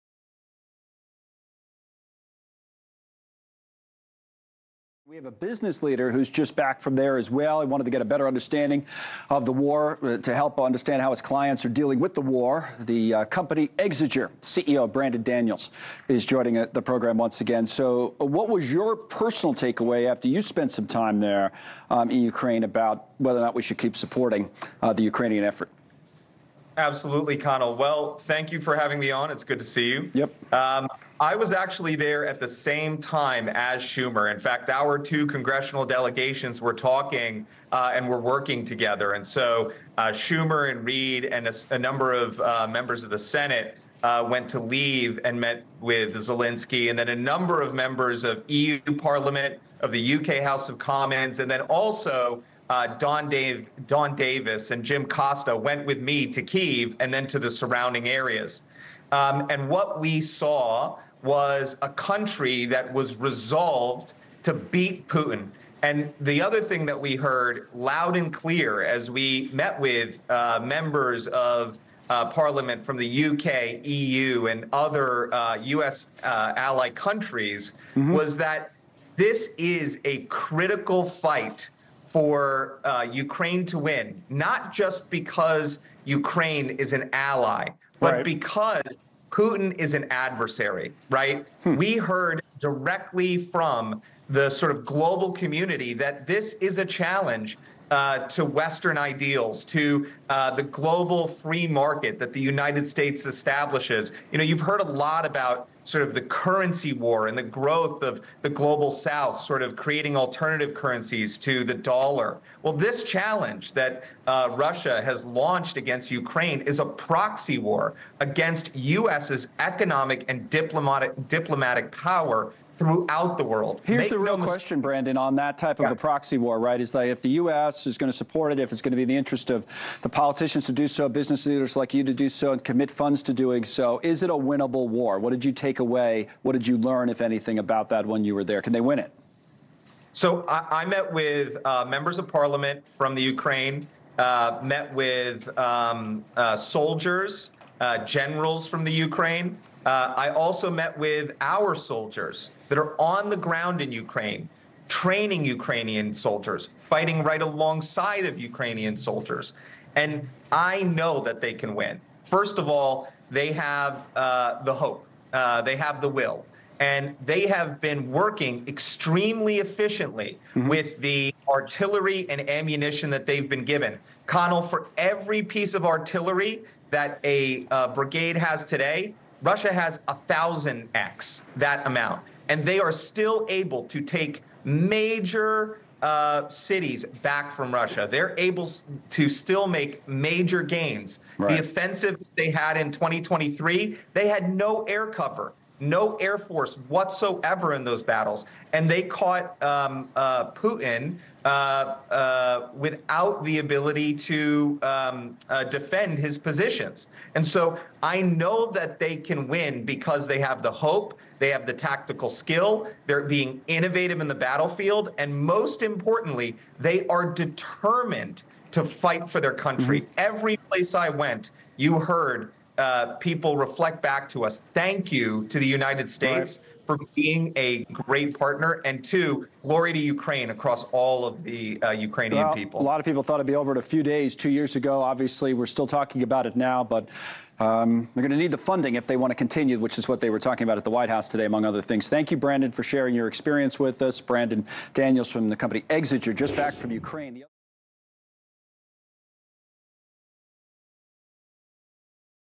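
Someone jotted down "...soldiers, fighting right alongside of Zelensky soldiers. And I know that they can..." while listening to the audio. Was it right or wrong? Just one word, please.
wrong.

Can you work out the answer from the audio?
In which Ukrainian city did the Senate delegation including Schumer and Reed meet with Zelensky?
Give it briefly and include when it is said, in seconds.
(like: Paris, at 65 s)
Lviv, at 44 s.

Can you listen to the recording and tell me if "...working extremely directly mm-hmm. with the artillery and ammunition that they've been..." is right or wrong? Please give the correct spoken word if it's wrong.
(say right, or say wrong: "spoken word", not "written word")
wrong: "efficiently", not "directly".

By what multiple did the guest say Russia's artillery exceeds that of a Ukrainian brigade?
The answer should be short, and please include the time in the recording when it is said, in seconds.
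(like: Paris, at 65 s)
1,000x, at 180 s.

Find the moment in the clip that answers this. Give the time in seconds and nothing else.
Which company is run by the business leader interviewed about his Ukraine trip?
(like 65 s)
13 s.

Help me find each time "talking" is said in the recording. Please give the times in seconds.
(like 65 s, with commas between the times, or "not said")
36 s, 235 s, 240 s.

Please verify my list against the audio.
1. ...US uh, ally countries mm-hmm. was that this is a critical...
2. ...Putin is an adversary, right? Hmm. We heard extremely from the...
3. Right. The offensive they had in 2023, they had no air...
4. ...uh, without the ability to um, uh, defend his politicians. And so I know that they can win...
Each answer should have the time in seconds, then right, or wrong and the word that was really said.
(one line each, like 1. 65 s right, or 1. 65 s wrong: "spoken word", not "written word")
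1. 75 s right
2. 89 s wrong: "directly", not "extremely"
3. 191 s right
4. 202 s wrong: "positions", not "politicians".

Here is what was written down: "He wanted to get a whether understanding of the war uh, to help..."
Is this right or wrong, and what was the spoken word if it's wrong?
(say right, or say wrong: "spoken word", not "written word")
wrong: "better", not "whether".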